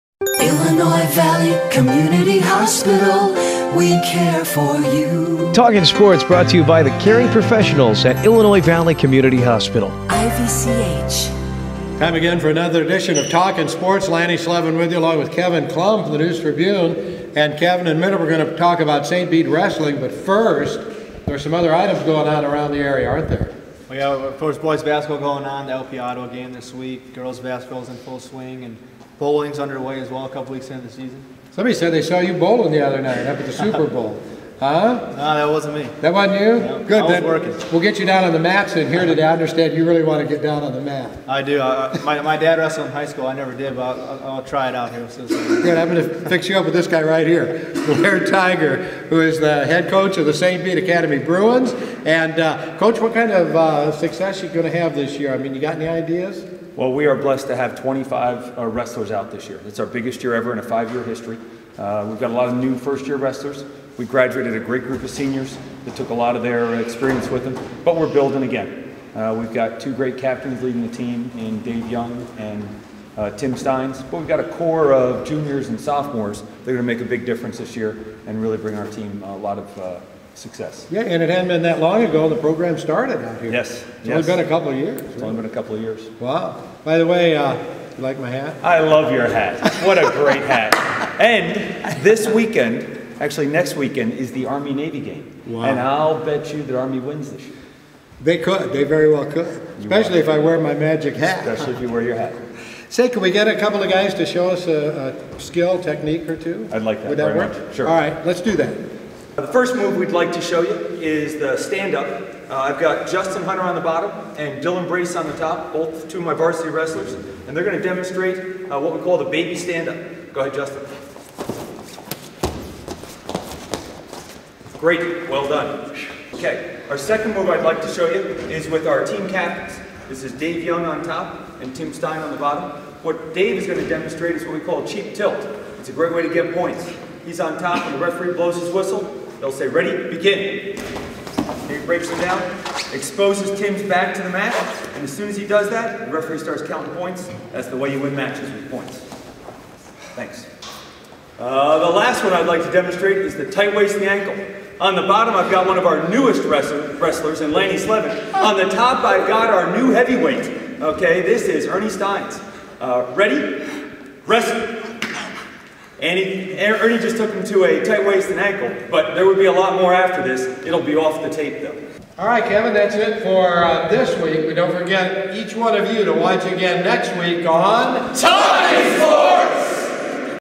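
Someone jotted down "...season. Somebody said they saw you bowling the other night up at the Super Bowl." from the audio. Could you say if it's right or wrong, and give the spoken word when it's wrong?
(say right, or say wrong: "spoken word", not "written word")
right.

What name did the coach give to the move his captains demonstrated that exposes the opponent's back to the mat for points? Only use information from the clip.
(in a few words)
cheap tilt.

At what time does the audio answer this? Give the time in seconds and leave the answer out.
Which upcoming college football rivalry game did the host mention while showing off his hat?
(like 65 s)
94 s.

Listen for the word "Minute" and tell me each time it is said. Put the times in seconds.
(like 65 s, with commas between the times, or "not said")
17 s.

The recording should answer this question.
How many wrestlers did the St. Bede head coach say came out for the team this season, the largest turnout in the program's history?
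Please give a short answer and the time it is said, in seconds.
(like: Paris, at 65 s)
25, at 57 s.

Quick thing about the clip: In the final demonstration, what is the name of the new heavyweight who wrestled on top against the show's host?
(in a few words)
Ernie Steins.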